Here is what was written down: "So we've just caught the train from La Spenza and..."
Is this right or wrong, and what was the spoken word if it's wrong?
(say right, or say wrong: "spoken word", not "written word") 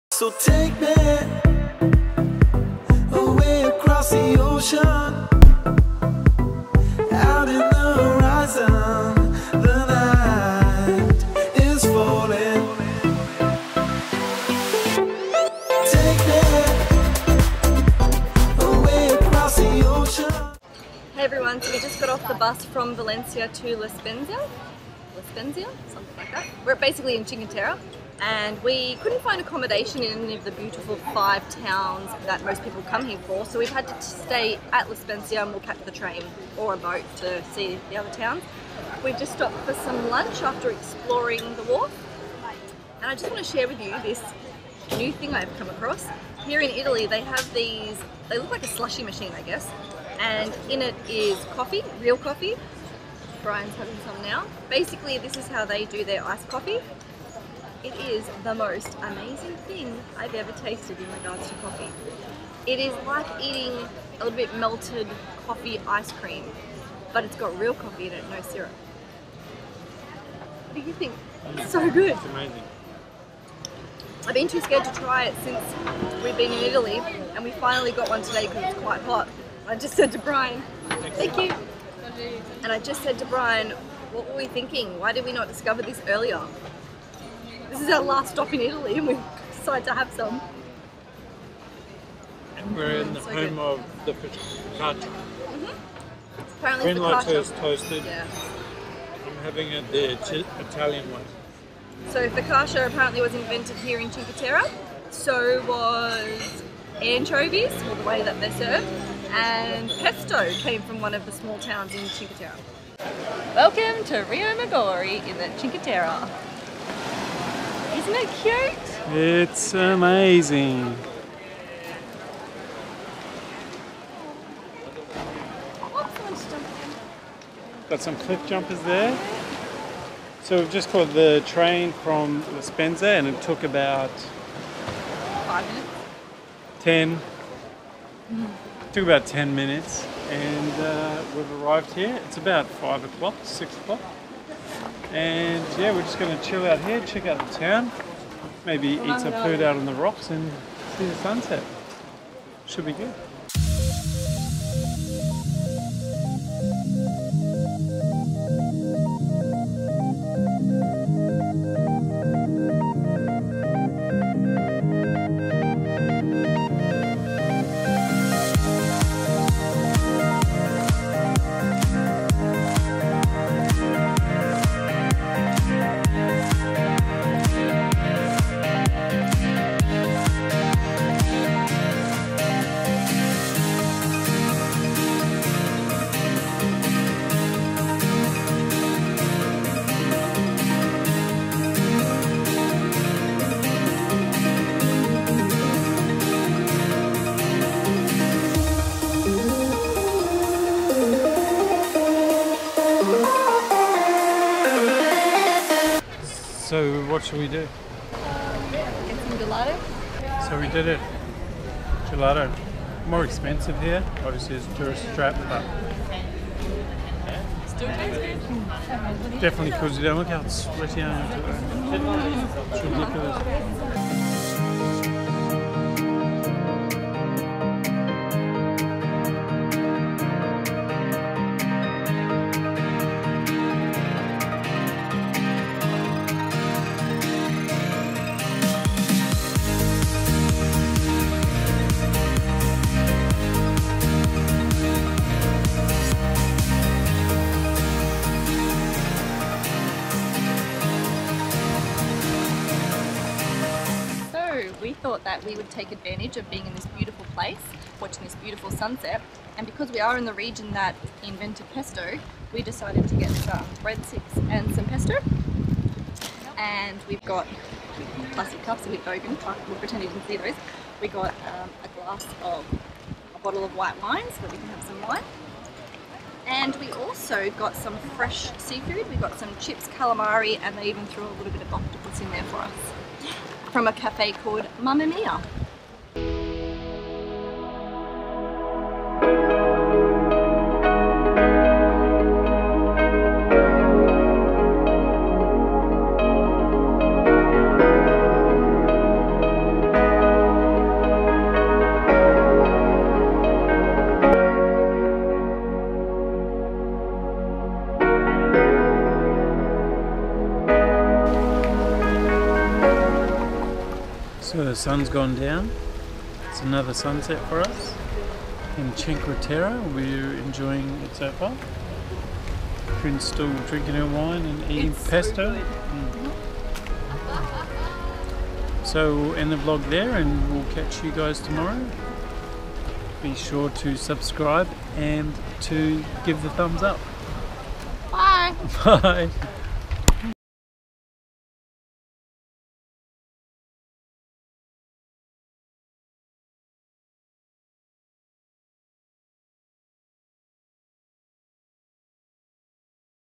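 right.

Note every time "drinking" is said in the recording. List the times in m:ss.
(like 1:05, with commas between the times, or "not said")
5:23.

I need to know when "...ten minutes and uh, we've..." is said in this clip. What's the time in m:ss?
2:19.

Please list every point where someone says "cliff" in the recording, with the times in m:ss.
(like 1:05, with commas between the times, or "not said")
2:08.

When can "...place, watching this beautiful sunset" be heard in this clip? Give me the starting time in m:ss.
4:17.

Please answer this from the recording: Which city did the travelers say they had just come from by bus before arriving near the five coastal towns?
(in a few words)
Valencia.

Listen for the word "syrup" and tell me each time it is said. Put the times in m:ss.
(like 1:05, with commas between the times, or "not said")
1:08.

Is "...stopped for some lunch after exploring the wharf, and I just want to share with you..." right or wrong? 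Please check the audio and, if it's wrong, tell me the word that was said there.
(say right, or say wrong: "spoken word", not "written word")
right.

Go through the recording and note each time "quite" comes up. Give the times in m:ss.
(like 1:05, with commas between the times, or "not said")
1:18.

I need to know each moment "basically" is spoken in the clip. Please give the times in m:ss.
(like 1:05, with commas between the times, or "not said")
0:26, 0:54.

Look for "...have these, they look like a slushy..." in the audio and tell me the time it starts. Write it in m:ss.
0:47.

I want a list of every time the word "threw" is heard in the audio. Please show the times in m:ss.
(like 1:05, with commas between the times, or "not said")
4:41.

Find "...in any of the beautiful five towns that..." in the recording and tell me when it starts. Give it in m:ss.
0:30.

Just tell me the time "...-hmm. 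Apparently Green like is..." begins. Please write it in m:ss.
1:34.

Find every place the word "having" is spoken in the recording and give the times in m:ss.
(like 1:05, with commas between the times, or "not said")
0:53, 1:39.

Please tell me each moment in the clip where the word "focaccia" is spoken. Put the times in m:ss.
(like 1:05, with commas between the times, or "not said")
1:34, 1:42.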